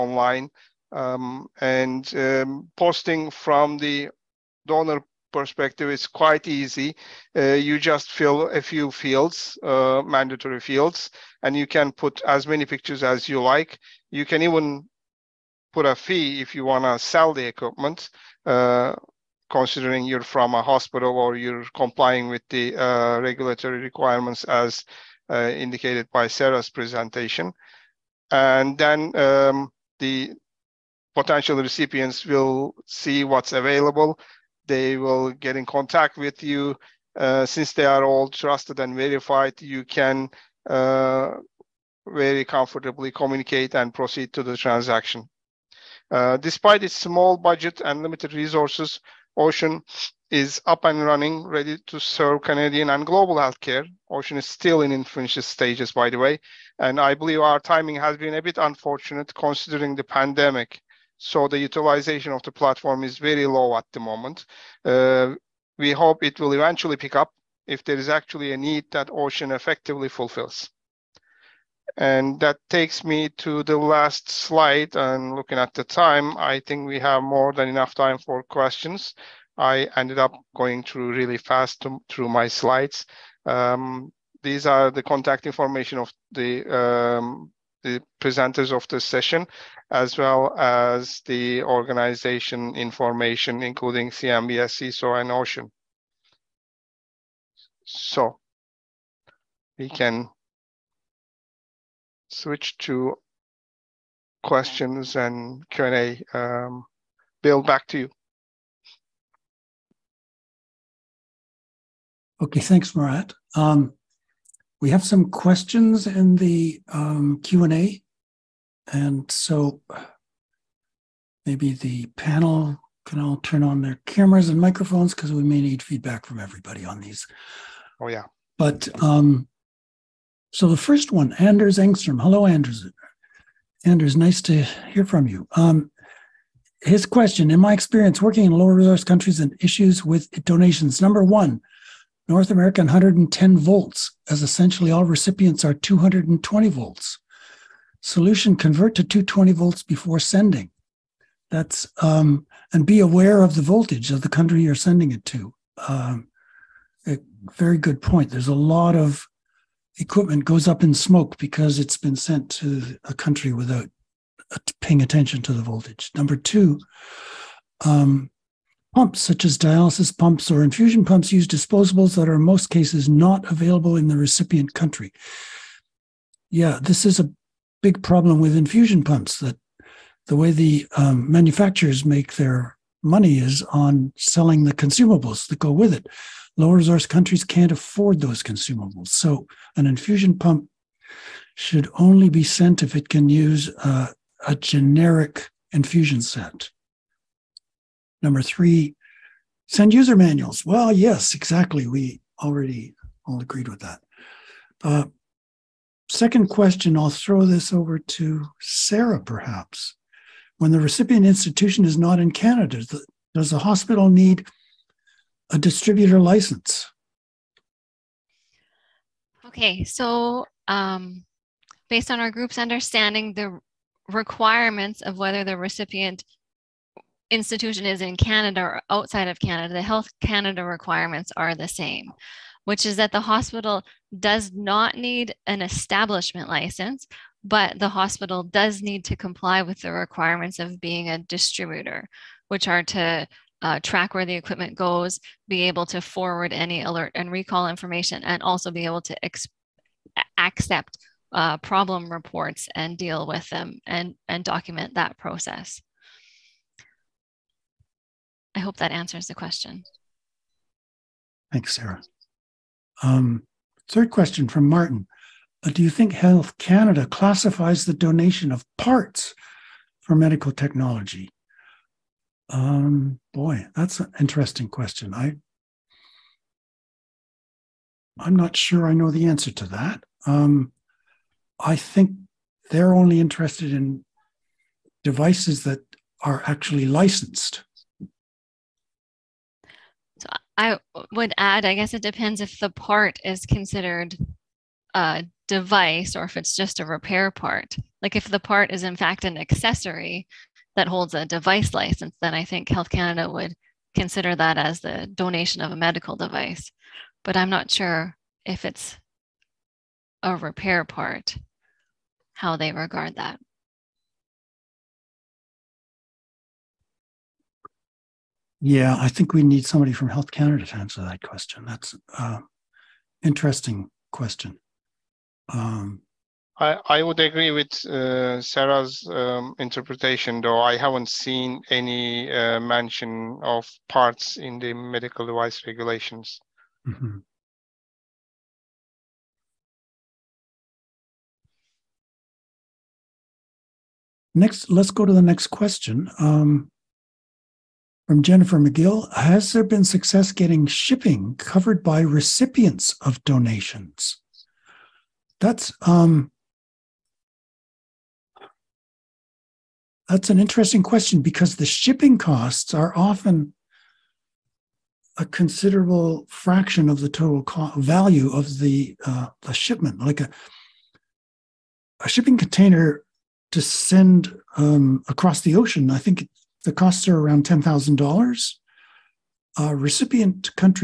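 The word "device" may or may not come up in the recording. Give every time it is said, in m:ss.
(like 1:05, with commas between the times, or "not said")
4:45, 4:55, 5:01, 5:06, 5:35.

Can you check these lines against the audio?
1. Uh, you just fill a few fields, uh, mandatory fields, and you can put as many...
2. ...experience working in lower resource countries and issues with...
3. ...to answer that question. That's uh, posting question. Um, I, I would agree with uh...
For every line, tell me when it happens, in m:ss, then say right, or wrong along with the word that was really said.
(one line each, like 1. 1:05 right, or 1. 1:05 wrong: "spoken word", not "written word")
1. 0:07 right
2. 2:17 right
3. 5:20 wrong: "interesting", not "posting".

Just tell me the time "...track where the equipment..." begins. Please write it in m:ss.
4:03.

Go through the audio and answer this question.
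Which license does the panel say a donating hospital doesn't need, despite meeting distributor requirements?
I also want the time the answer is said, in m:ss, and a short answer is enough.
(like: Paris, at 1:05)
establishment license, at 3:55.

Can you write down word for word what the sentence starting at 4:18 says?
I hope that answers the question.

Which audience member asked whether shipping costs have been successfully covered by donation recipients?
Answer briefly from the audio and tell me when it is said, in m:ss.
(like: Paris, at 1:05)
Jennifer McGill, at 5:48.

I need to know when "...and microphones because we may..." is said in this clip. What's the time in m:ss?
2:04.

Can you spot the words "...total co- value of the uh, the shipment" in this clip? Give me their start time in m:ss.
6:07.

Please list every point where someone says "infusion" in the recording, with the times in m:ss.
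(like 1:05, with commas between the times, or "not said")
2:50, 2:58, 3:09, 3:15.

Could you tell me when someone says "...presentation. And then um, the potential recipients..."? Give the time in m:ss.
0:26.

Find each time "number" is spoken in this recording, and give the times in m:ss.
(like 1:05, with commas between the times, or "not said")
2:21, 2:46, 3:18.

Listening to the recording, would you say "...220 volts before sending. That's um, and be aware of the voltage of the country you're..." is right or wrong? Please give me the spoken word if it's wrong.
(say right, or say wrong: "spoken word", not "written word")
right.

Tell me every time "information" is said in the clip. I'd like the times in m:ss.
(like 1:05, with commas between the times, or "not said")
1:25, 1:32, 4:07.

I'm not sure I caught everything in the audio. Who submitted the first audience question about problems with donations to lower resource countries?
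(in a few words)
Anders Engstrom.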